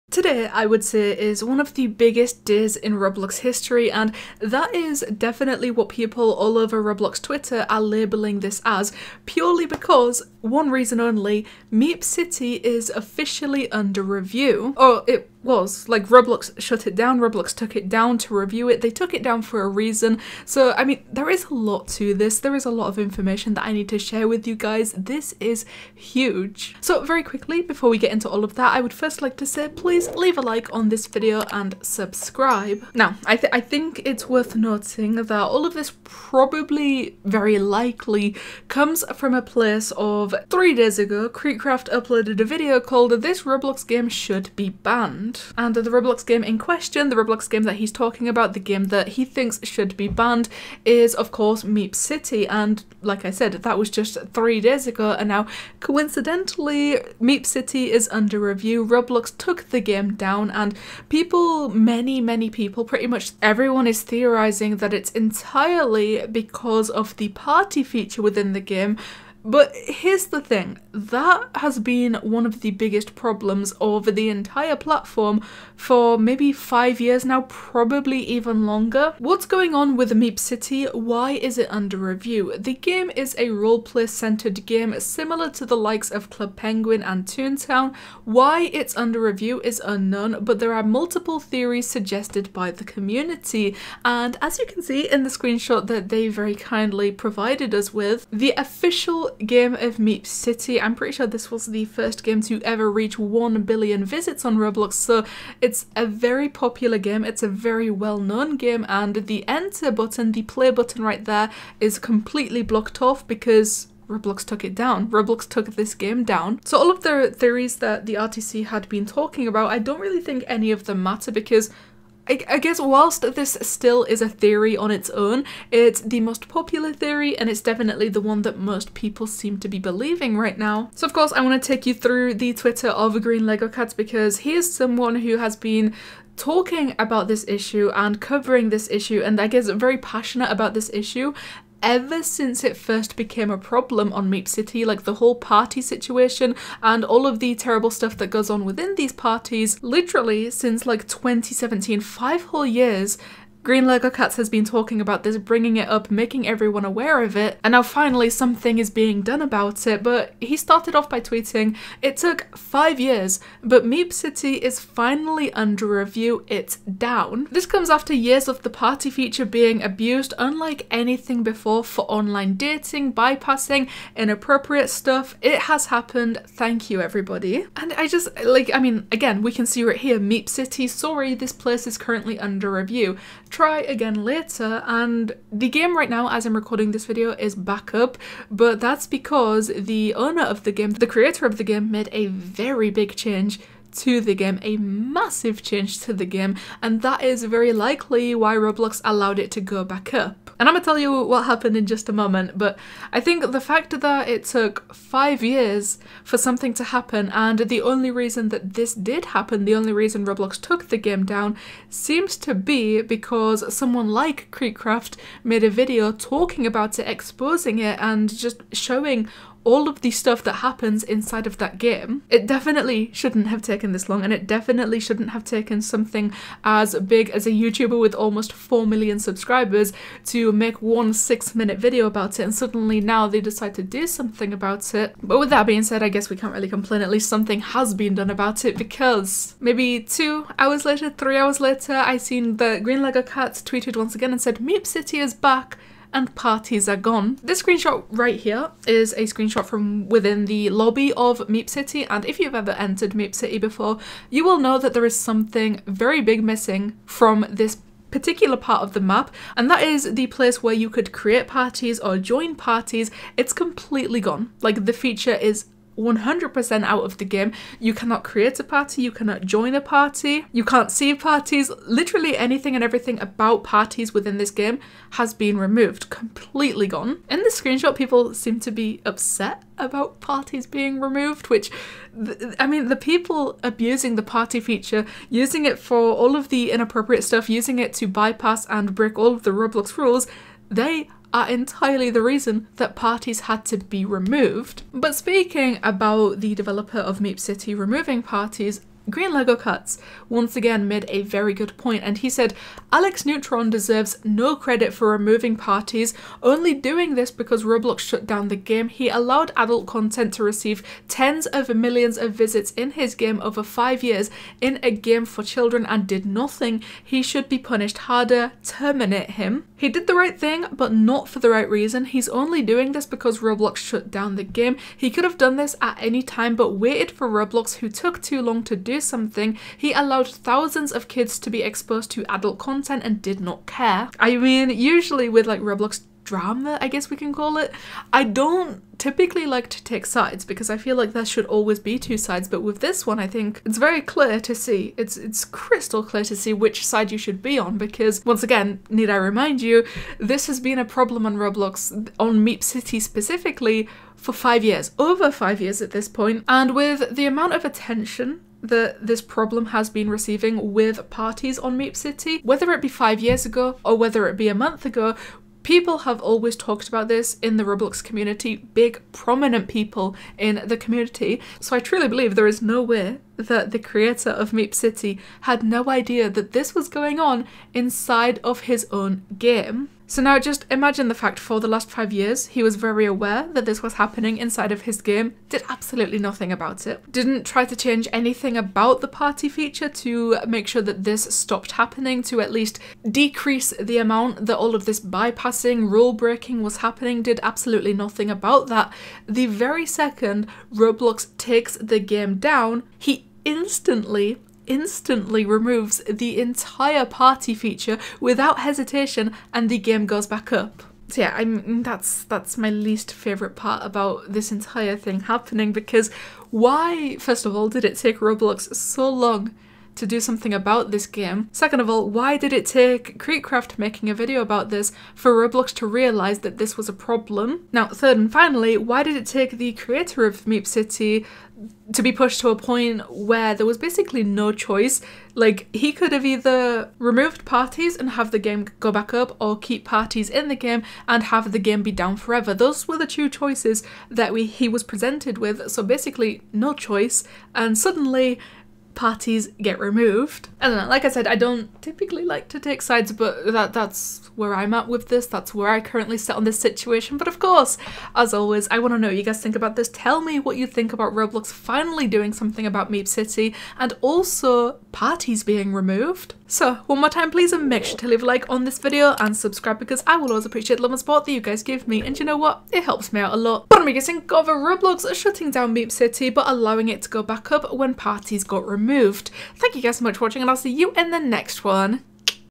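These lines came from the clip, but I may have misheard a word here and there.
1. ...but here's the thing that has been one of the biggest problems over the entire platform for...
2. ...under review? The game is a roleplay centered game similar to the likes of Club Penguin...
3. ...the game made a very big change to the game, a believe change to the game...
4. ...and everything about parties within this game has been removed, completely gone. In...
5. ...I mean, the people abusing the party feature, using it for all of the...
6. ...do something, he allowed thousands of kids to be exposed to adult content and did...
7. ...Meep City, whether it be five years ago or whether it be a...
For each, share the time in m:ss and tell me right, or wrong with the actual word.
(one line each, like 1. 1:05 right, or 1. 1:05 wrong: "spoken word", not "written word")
1. 1:09 right
2. 1:21 right
3. 3:11 wrong: "massive", not "believe"
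4. 4:32 right
5. 4:42 right
6. 5:28 right
7. 6:01 right.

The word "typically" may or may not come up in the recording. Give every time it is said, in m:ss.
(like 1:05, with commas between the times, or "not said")
5:38, 7:31.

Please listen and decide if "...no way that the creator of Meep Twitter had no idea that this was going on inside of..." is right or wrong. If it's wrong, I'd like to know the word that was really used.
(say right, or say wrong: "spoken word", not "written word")
wrong: "City", not "Twitter".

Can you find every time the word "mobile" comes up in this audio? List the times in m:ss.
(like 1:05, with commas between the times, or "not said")
not said.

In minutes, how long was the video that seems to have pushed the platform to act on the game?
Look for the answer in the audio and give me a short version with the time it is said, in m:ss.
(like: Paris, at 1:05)
6, at 3:51.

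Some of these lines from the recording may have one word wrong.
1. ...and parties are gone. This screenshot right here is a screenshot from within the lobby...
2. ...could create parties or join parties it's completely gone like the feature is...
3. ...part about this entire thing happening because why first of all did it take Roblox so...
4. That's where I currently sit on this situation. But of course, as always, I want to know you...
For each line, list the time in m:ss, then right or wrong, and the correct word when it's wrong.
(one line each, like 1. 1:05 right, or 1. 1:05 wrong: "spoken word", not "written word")
1. 4:06 right
2. 4:20 right
3. 6:53 right
4. 7:35 right.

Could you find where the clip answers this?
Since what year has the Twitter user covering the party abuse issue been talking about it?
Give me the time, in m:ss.
2:31.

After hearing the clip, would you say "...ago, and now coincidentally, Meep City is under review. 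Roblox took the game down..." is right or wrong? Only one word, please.
right.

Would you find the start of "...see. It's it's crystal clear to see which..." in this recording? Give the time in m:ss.
5:44.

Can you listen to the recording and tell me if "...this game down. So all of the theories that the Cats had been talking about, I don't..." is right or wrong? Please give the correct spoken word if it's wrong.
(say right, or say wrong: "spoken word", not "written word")
wrong: "RTC", not "Cats".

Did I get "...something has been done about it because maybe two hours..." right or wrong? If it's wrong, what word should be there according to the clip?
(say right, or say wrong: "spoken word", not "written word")
right.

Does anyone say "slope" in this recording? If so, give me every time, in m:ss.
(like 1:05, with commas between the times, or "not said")
not said.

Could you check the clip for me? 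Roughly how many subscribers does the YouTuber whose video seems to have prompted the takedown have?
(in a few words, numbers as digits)
almost 4 million.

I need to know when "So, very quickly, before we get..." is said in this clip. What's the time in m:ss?
0:26.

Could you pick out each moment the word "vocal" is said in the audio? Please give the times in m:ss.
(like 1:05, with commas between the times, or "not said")
not said.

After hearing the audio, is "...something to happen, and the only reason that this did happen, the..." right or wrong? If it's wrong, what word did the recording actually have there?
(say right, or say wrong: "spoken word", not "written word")
right.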